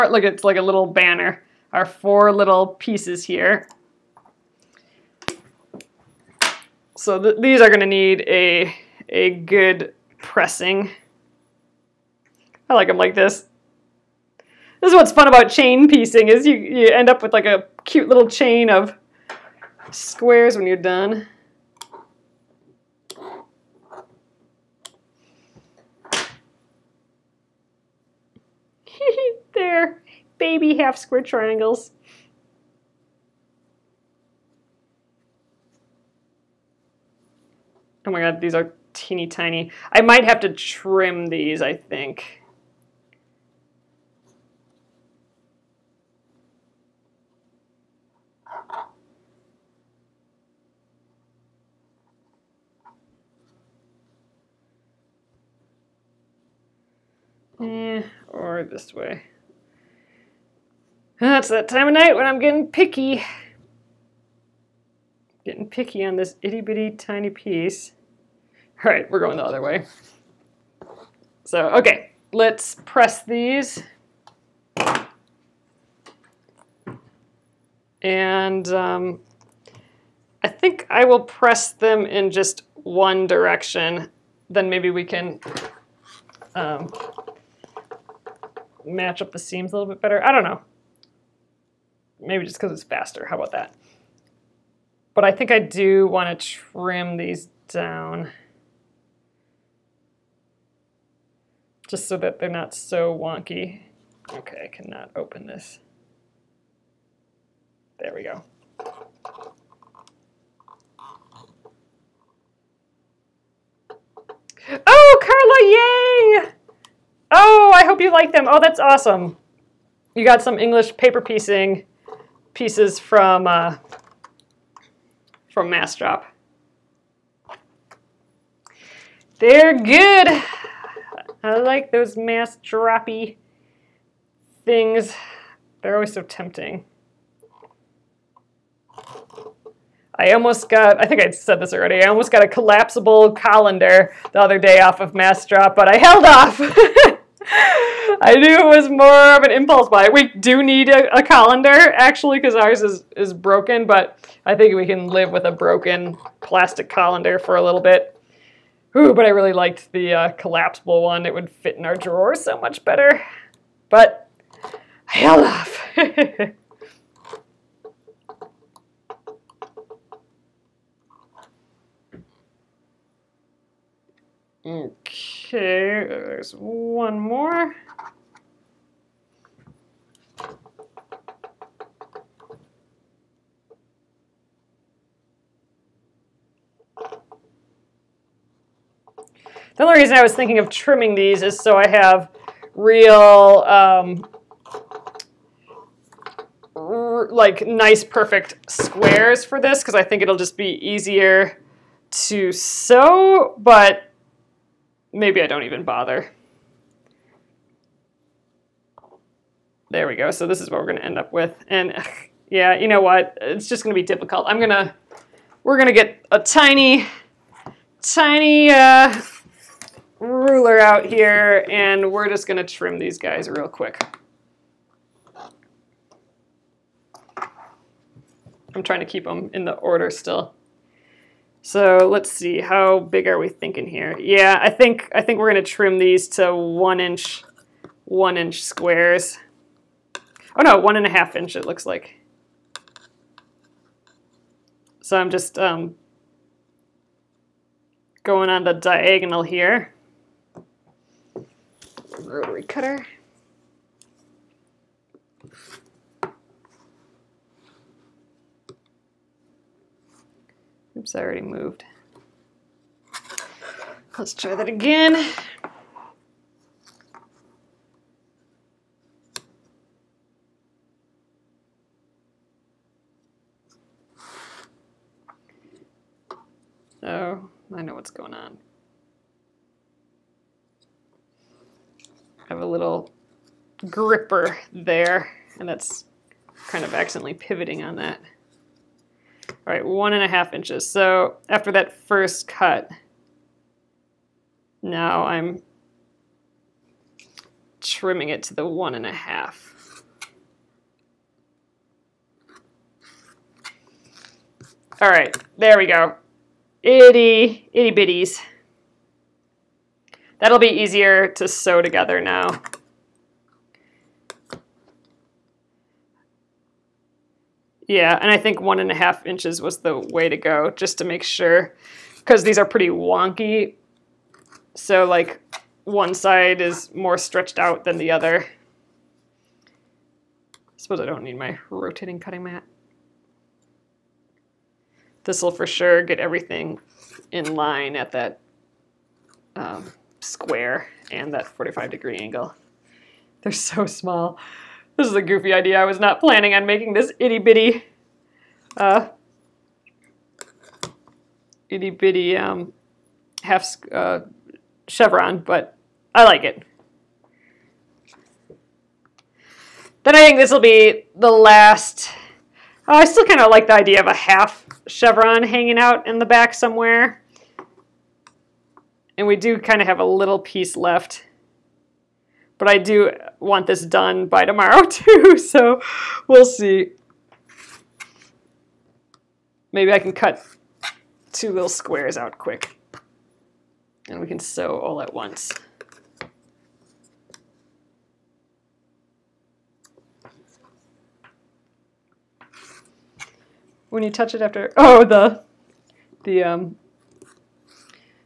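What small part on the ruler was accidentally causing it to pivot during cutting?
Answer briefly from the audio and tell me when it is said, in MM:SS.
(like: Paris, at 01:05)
gripper, at 04:43.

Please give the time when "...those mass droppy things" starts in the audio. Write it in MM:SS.
02:11.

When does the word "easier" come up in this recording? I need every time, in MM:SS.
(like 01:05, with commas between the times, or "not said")
03:20, 05:10.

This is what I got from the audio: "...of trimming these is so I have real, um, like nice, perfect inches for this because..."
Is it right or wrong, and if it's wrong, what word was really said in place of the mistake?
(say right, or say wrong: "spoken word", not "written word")
wrong: "squares", not "inches".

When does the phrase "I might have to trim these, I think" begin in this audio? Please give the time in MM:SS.
00:39.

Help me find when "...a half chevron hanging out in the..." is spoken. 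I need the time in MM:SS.
06:04.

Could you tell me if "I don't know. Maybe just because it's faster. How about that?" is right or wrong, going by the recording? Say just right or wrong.
right.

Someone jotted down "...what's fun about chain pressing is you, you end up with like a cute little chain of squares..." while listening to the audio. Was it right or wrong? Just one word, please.
wrong.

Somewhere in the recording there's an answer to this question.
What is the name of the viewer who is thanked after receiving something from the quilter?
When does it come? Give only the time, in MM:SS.
01:55.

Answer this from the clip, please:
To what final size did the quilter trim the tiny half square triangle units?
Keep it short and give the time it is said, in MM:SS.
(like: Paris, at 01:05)
1.5 inches, at 04:00.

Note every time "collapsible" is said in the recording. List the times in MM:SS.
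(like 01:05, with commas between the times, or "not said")
02:22, 02:40.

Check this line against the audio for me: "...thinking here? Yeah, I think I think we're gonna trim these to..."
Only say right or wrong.
right.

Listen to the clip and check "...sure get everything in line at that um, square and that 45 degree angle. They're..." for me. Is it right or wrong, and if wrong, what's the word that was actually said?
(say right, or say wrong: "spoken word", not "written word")
right.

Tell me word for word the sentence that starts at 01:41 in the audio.
Just so that they're not so wonky.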